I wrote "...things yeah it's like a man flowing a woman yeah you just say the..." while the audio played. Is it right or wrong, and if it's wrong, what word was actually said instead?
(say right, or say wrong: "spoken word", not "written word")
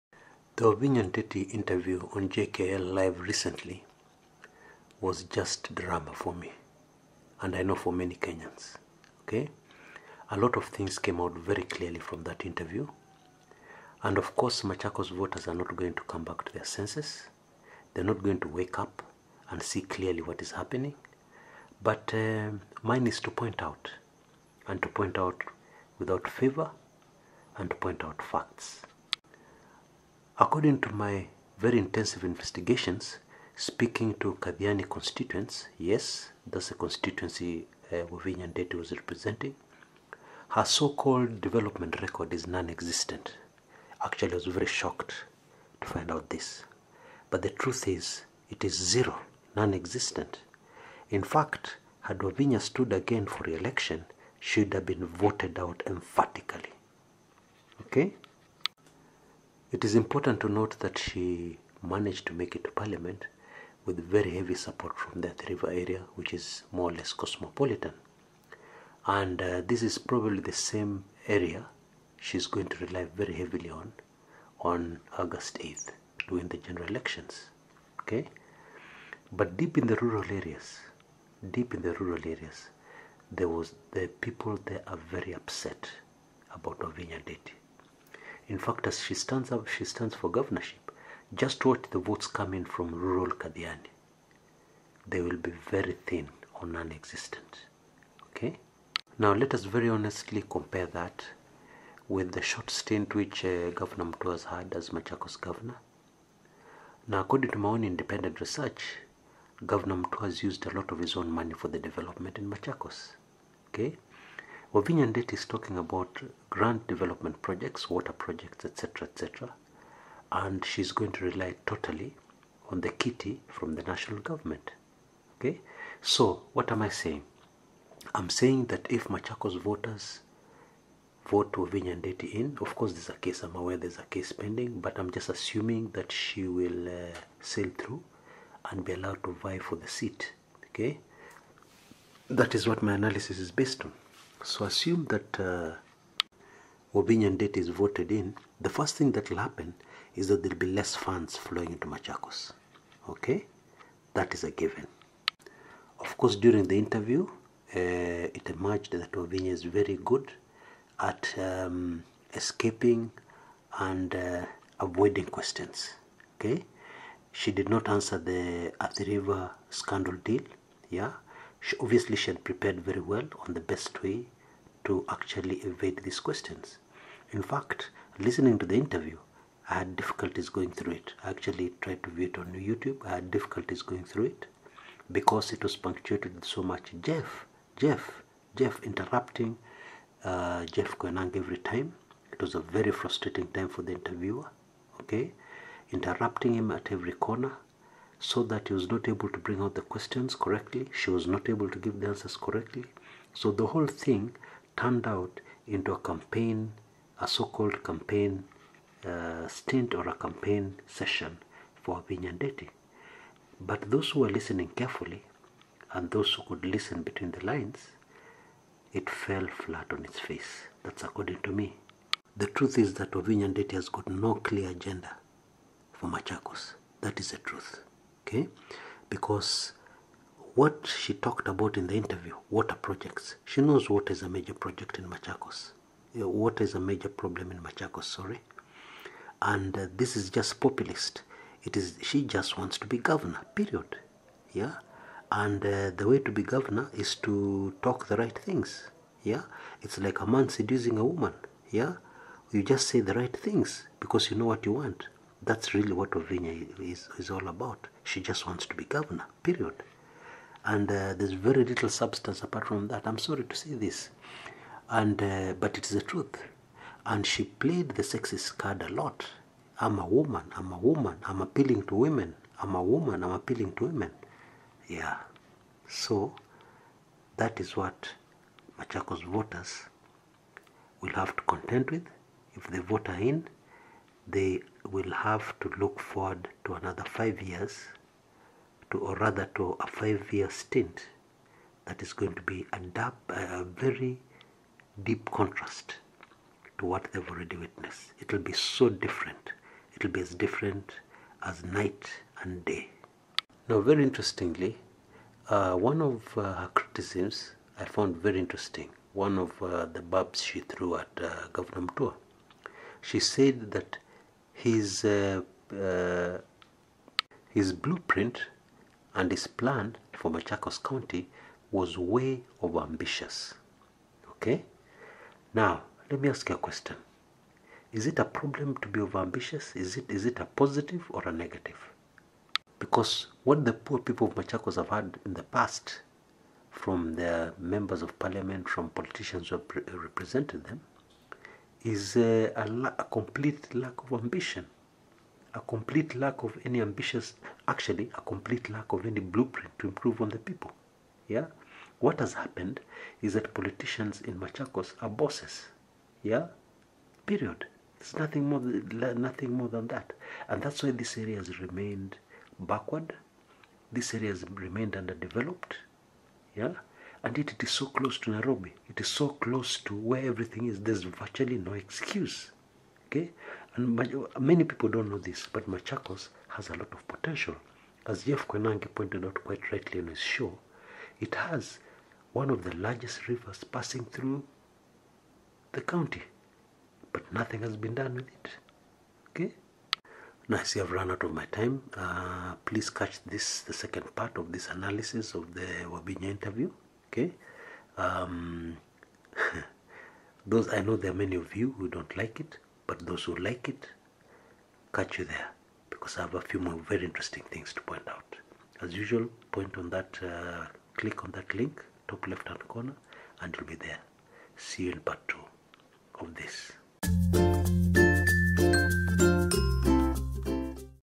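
wrong: "seducing", not "flowing".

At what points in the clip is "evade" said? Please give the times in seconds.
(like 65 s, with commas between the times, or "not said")
175 s.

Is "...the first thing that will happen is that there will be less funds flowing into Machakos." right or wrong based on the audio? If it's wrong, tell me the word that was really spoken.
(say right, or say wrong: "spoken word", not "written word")
right.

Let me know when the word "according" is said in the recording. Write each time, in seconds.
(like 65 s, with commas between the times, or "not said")
30 s, 107 s, 221 s.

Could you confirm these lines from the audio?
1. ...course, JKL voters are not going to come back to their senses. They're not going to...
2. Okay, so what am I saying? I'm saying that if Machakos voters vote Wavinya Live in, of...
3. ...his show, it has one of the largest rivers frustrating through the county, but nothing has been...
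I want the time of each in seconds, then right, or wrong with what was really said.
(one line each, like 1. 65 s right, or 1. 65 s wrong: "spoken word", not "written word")
1. 14 s wrong: "Machakos", not "JKL"
2. 125 s wrong: "Ndeti", not "Live"
3. 380 s wrong: "passing", not "frustrating".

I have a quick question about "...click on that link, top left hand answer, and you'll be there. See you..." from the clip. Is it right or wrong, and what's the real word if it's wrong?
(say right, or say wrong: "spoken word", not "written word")
wrong: "corner", not "answer".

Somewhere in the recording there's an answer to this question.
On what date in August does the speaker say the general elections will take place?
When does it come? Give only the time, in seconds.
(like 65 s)
75 s.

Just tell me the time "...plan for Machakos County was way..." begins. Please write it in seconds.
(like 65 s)
319 s.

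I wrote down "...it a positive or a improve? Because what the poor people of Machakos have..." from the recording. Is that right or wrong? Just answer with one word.
wrong.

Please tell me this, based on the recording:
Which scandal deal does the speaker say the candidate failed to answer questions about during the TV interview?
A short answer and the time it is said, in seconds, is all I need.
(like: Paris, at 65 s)
Athi River scandal, at 168 s.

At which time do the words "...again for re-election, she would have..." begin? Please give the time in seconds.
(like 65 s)
52 s.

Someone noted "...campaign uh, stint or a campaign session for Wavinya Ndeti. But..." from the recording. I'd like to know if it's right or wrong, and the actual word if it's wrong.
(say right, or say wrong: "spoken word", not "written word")
right.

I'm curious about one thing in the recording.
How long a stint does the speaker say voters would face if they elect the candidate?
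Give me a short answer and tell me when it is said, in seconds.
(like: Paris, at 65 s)
5 years, at 289 s.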